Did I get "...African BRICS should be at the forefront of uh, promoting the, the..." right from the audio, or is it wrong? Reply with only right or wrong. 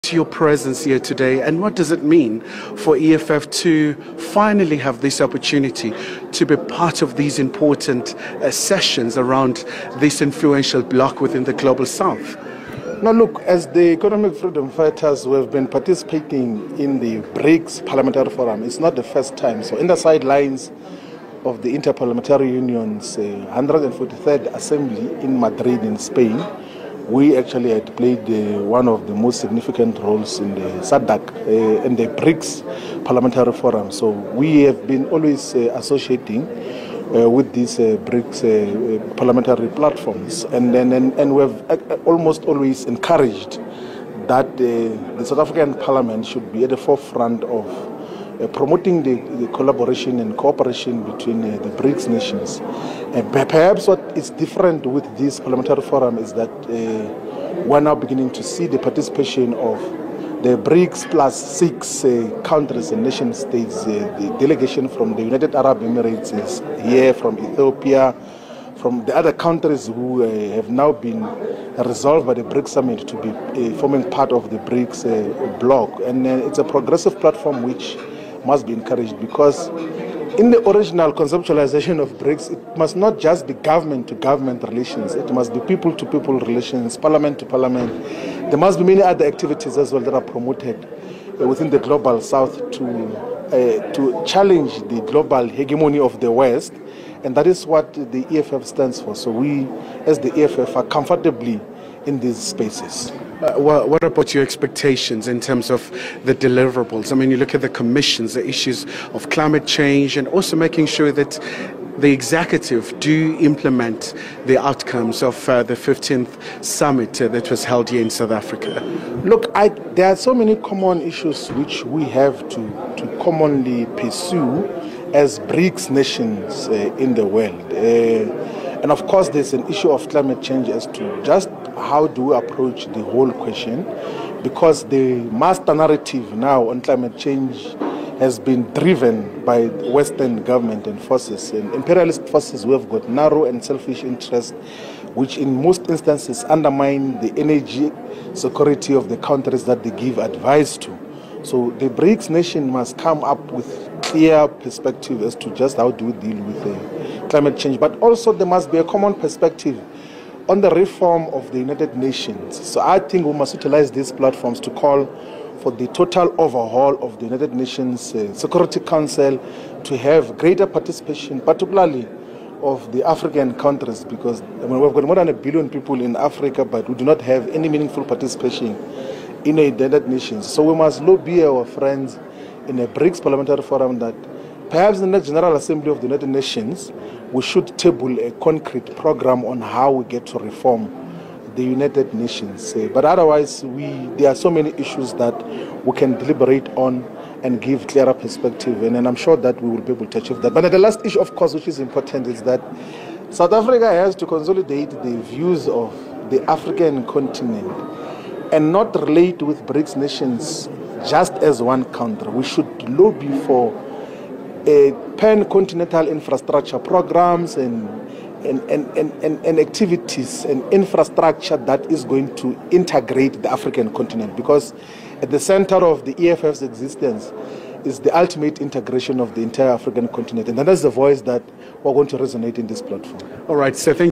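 wrong.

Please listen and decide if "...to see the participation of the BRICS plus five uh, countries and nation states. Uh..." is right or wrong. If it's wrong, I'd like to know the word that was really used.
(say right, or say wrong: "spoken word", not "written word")
wrong: "six", not "five".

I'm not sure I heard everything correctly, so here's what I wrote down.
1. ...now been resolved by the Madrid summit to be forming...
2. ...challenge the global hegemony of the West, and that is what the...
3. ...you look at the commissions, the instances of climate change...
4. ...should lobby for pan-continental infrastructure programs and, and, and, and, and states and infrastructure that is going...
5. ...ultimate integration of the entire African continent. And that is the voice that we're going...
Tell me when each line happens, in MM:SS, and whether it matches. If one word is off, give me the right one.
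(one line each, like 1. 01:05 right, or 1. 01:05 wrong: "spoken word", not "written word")
1. 01:10 wrong: "BRICS", not "Madrid"
2. 01:34 right
3. 01:47 wrong: "issues", not "instances"
4. 03:32 wrong: "activities", not "states"
5. 03:48 right.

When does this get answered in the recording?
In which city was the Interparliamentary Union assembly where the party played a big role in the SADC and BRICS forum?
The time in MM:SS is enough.
00:25.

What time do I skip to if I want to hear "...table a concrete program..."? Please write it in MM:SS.
03:07.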